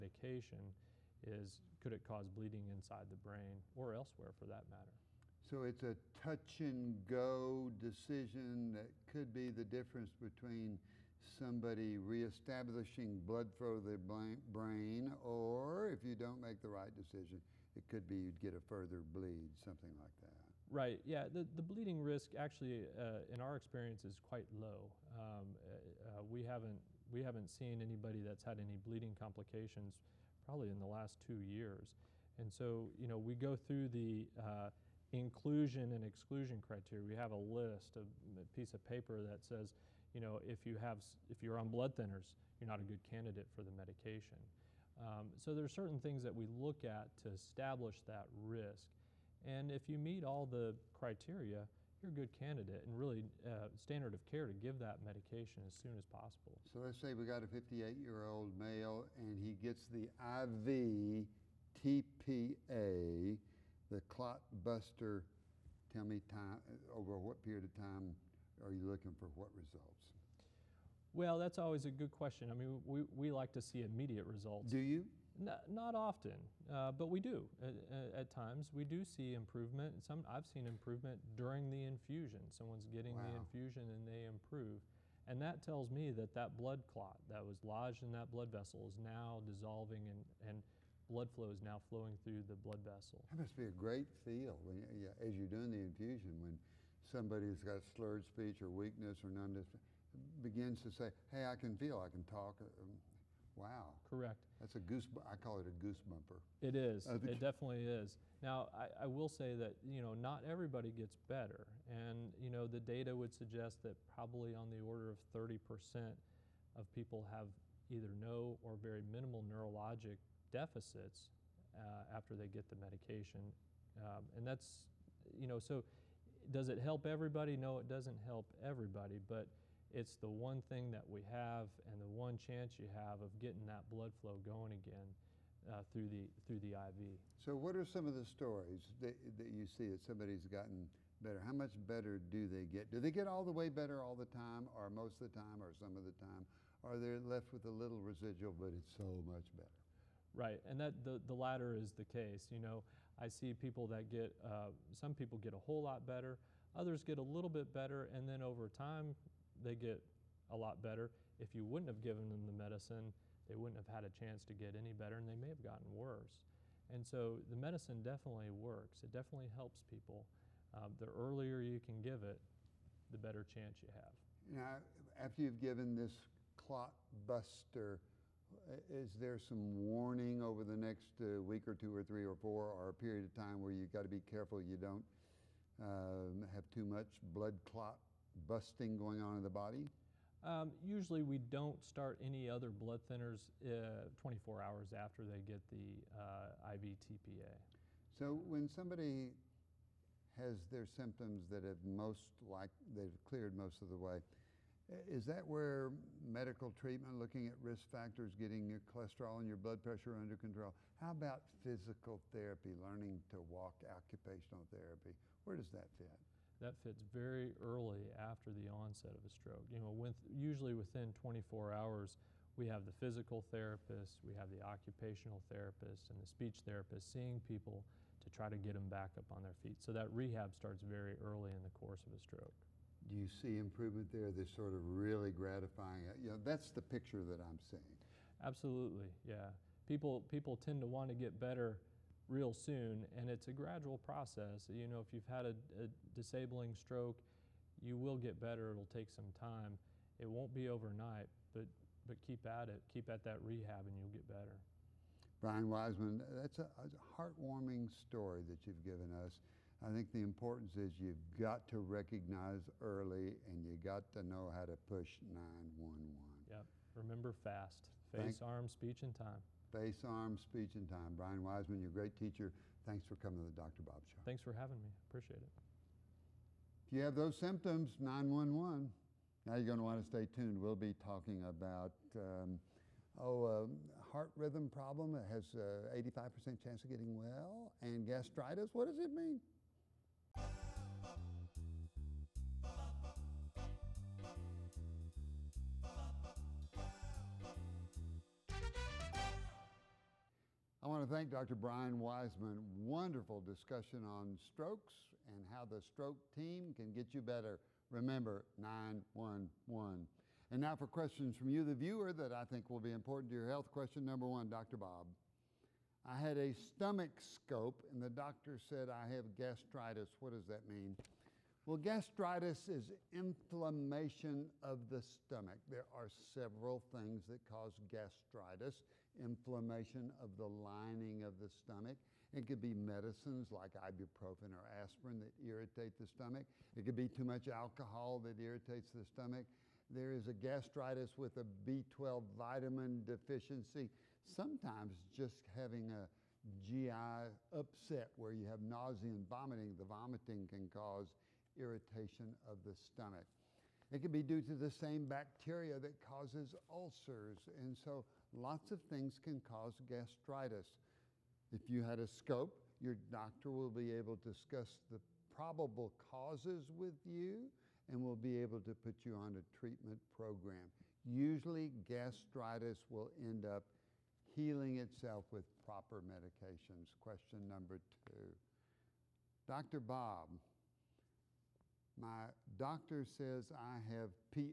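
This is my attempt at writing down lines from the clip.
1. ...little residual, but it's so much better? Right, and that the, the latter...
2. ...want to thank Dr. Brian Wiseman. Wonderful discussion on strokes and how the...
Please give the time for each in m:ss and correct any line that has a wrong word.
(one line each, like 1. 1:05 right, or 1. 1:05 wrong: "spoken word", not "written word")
1. 2:27 right
2. 5:00 right.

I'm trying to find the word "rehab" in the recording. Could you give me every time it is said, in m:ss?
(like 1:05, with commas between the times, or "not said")
3:50, 4:13.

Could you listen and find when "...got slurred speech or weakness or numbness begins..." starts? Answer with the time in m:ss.
1:37.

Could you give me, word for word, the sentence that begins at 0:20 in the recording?
Right, yeah, the, the bleeding risk actually, uh, in our experience, is quite low.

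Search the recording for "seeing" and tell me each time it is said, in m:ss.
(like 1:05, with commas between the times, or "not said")
3:47, 3:57.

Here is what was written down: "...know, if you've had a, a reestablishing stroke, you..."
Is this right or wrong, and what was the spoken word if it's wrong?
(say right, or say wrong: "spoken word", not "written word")
wrong: "disabling", not "reestablishing".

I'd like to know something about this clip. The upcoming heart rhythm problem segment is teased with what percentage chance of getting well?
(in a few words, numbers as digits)
85%.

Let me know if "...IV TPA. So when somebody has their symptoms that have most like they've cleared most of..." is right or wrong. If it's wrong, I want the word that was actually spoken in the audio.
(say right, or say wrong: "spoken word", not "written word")
right.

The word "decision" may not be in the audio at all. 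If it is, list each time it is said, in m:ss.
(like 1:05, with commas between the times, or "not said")
0:07, 0:16.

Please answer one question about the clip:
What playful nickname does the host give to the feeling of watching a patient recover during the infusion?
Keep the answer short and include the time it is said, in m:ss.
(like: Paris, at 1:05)
goose bumper, at 1:45.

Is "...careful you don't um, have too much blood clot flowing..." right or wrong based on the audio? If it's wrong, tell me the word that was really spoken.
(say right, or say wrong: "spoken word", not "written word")
wrong: "busting", not "flowing".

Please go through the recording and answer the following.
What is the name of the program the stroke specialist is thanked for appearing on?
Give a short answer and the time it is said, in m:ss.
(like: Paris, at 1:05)
Dr. Bob Show, at 4:33.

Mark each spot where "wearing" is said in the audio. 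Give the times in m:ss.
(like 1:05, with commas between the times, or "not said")
not said.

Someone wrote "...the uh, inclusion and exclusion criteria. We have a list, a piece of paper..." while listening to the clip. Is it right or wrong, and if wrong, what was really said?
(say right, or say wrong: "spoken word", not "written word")
right.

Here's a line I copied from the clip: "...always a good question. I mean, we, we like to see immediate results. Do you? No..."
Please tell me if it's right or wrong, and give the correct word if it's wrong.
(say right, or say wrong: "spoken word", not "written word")
right.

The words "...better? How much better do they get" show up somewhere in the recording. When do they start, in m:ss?
2:21.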